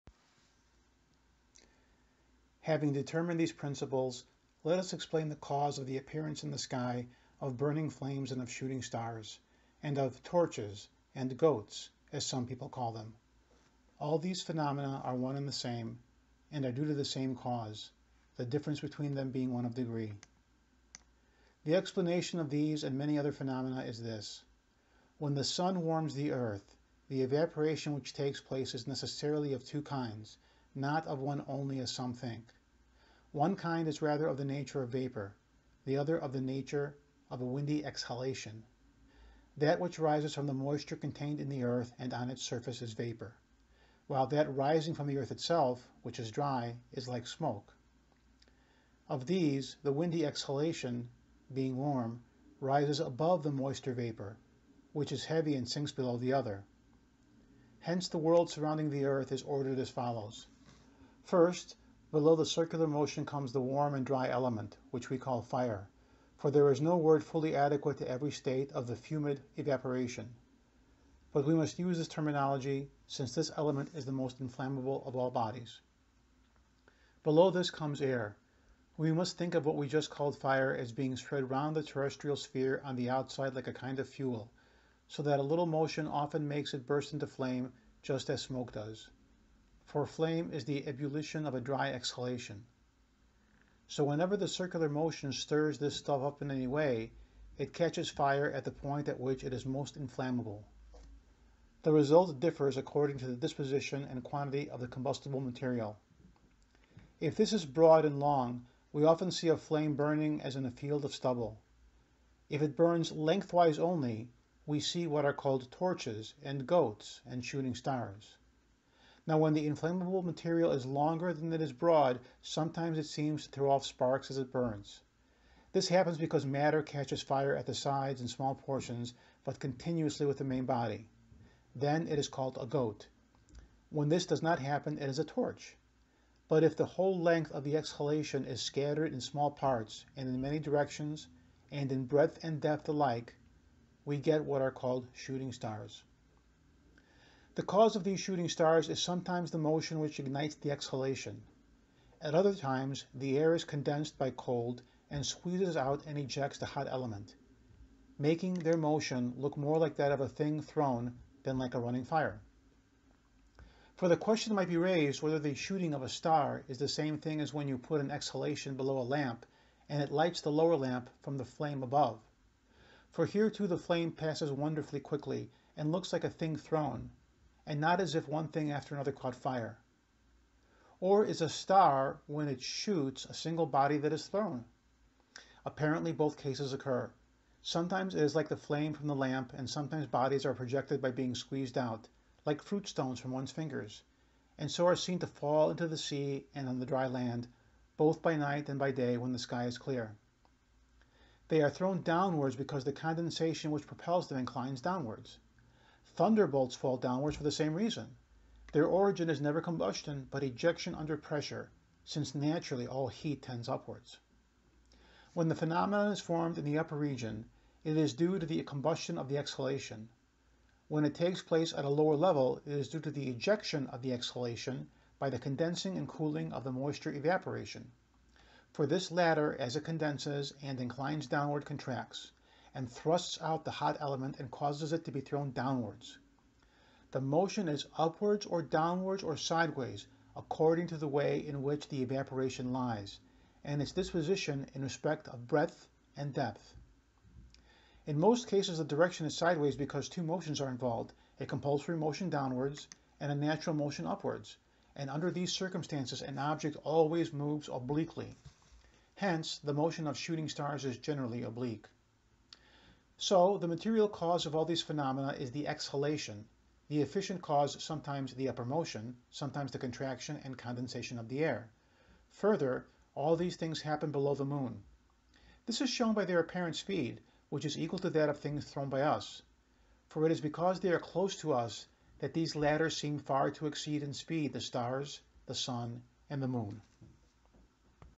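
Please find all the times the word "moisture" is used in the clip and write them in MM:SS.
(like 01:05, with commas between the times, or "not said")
00:40, 00:53, 03:46.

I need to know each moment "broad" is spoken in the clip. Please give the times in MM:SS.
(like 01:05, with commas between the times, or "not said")
01:47, 02:01.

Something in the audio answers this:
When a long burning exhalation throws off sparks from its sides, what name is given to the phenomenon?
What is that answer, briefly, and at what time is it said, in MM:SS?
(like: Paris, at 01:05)
A goat, at 02:12.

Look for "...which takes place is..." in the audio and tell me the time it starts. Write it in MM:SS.
00:27.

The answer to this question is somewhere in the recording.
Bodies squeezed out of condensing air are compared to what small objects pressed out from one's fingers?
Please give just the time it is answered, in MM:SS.
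03:12.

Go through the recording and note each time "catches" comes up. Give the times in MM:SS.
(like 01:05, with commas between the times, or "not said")
01:37, 02:06.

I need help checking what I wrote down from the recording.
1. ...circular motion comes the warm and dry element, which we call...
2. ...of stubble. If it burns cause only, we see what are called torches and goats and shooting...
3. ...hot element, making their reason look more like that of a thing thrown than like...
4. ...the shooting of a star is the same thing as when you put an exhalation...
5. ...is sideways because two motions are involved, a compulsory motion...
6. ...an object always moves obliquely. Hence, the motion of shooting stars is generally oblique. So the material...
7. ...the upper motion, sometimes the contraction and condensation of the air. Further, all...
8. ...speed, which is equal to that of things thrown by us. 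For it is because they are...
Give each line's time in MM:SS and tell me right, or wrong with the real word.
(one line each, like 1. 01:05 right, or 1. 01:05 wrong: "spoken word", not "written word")
1. 01:02 right
2. 01:51 wrong: "lengthwise", not "cause"
3. 02:36 wrong: "motion", not "reason"
4. 02:45 right
5. 04:09 right
6. 04:16 right
7. 04:28 right
8. 04:36 right.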